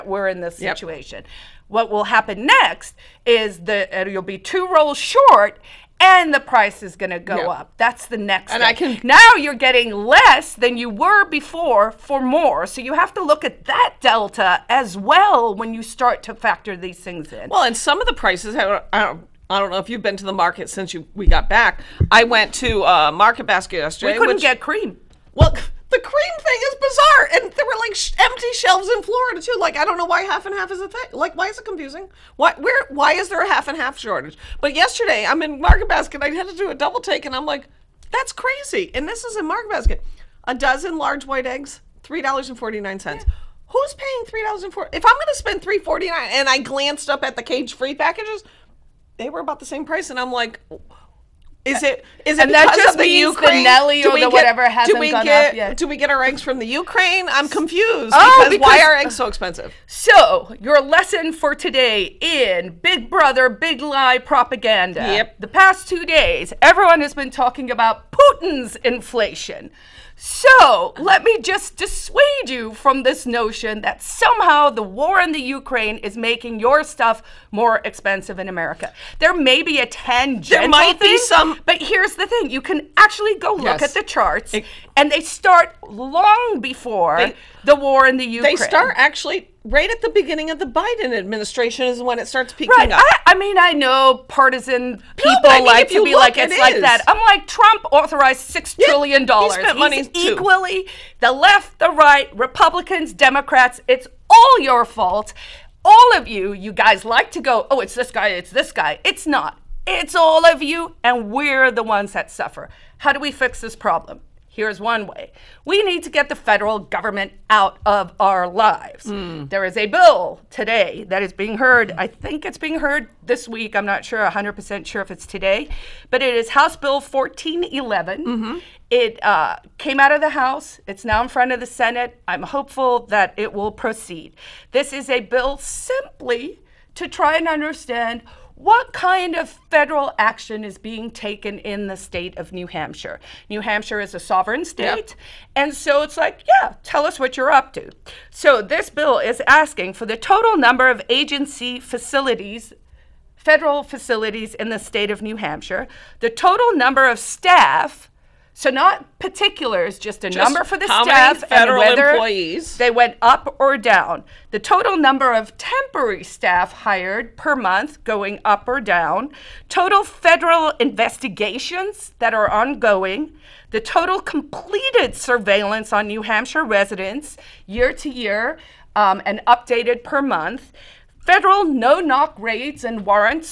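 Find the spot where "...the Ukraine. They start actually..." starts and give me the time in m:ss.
1:28.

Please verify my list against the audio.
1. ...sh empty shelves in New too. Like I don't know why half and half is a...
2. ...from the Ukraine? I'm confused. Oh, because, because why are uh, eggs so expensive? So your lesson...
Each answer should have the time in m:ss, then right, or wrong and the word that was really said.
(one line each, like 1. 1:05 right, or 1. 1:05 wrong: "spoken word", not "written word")
1. 0:27 wrong: "Florida", not "New"
2. 0:56 right.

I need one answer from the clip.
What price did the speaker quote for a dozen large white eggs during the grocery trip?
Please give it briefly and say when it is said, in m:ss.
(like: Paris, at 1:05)
$3.49, at 0:42.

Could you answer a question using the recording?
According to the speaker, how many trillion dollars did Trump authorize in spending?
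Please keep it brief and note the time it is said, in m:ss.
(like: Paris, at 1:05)
6 trillion, at 1:38.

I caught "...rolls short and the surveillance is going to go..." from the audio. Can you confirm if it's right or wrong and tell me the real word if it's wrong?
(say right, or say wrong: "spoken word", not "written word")
wrong: "price", not "surveillance".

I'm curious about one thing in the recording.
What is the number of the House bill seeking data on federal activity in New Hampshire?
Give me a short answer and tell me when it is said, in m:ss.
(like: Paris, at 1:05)
1411, at 2:06.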